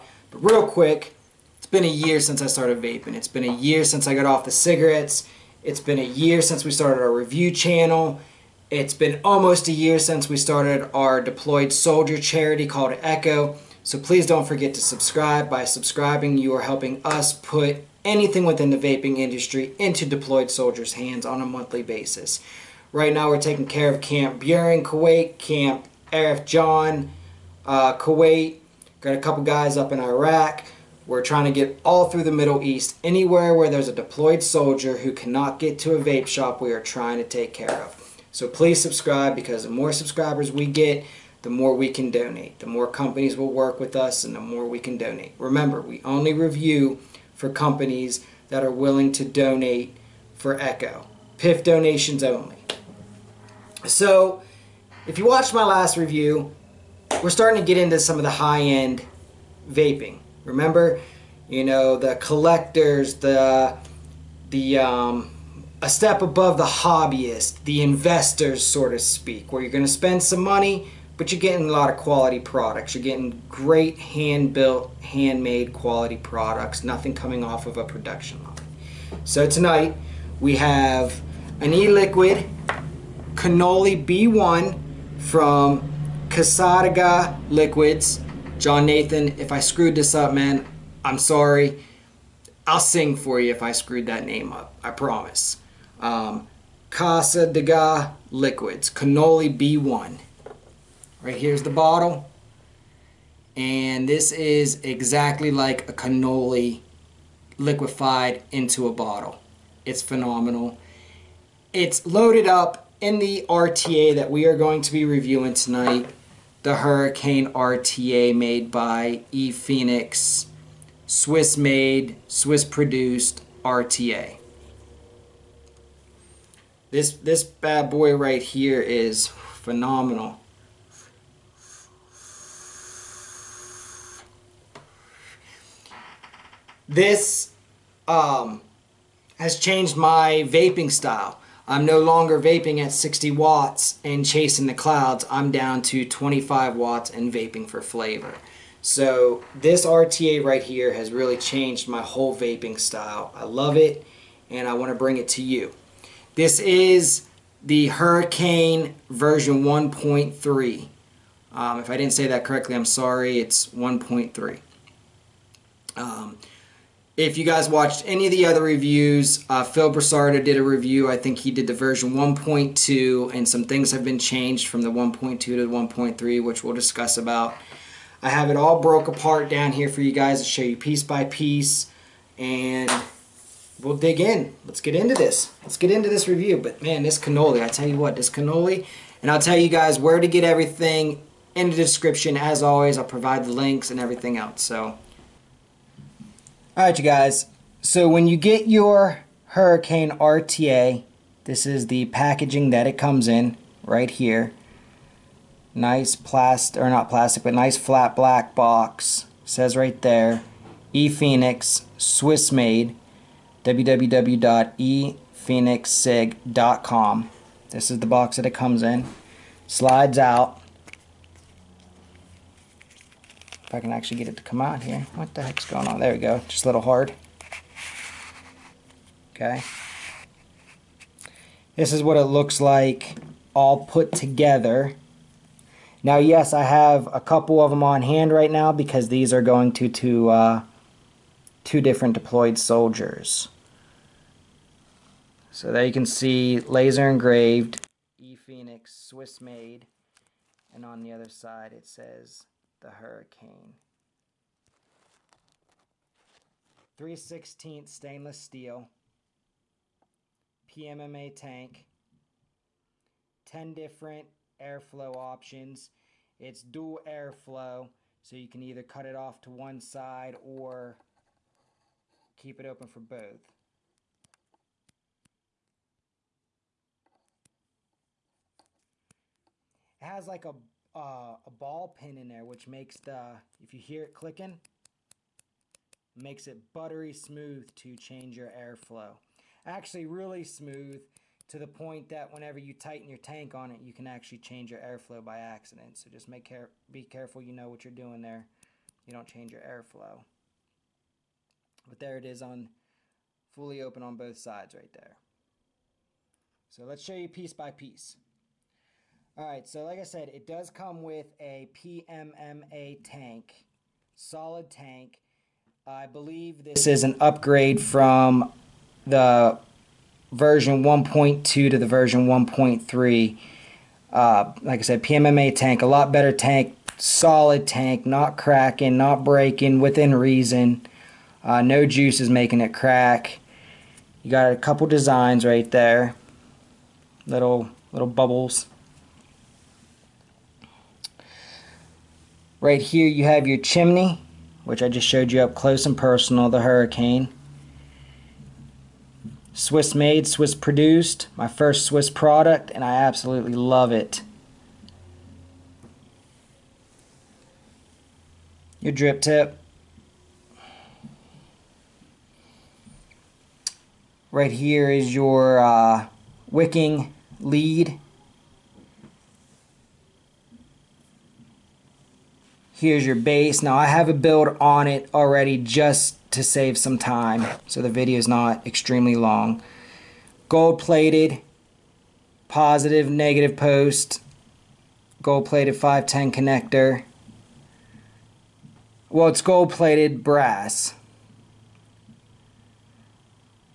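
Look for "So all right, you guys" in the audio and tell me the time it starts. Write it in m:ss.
3:14.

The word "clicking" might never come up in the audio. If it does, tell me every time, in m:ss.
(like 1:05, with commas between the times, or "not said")
4:44.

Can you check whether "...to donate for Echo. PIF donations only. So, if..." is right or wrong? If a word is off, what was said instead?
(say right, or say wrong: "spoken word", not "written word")
right.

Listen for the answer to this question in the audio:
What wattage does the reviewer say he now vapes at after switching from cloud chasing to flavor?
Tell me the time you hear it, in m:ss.
2:26.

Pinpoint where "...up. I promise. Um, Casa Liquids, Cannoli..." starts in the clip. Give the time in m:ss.
1:34.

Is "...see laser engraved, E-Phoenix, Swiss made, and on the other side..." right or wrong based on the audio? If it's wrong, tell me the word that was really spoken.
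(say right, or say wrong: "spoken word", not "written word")
right.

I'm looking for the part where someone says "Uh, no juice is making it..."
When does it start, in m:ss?
5:31.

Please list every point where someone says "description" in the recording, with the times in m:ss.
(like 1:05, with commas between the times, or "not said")
3:11.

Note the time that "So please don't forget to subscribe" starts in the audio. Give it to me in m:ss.
0:13.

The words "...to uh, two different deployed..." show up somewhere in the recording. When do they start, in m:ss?
3:59.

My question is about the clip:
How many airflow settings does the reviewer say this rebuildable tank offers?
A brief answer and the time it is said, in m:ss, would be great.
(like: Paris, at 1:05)
10, at 4:23.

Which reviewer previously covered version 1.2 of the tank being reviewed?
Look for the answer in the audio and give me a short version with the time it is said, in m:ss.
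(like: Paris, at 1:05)
Phil Busardo, at 2:49.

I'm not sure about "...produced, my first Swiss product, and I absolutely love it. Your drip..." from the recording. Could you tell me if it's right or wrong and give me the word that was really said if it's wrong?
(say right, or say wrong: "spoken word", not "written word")
right.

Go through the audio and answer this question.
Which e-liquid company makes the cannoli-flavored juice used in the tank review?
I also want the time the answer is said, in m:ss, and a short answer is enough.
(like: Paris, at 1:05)
Cassadaga Liquids, at 1:26.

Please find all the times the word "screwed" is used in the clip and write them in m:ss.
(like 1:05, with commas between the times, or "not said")
1:29, 1:33.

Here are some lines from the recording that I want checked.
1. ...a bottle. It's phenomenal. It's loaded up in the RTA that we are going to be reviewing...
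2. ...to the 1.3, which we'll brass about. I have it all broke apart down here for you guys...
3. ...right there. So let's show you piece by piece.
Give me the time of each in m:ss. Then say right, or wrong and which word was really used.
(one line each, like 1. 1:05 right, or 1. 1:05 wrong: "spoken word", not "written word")
1. 1:48 right
2. 2:55 wrong: "discuss", not "brass"
3. 5:04 right.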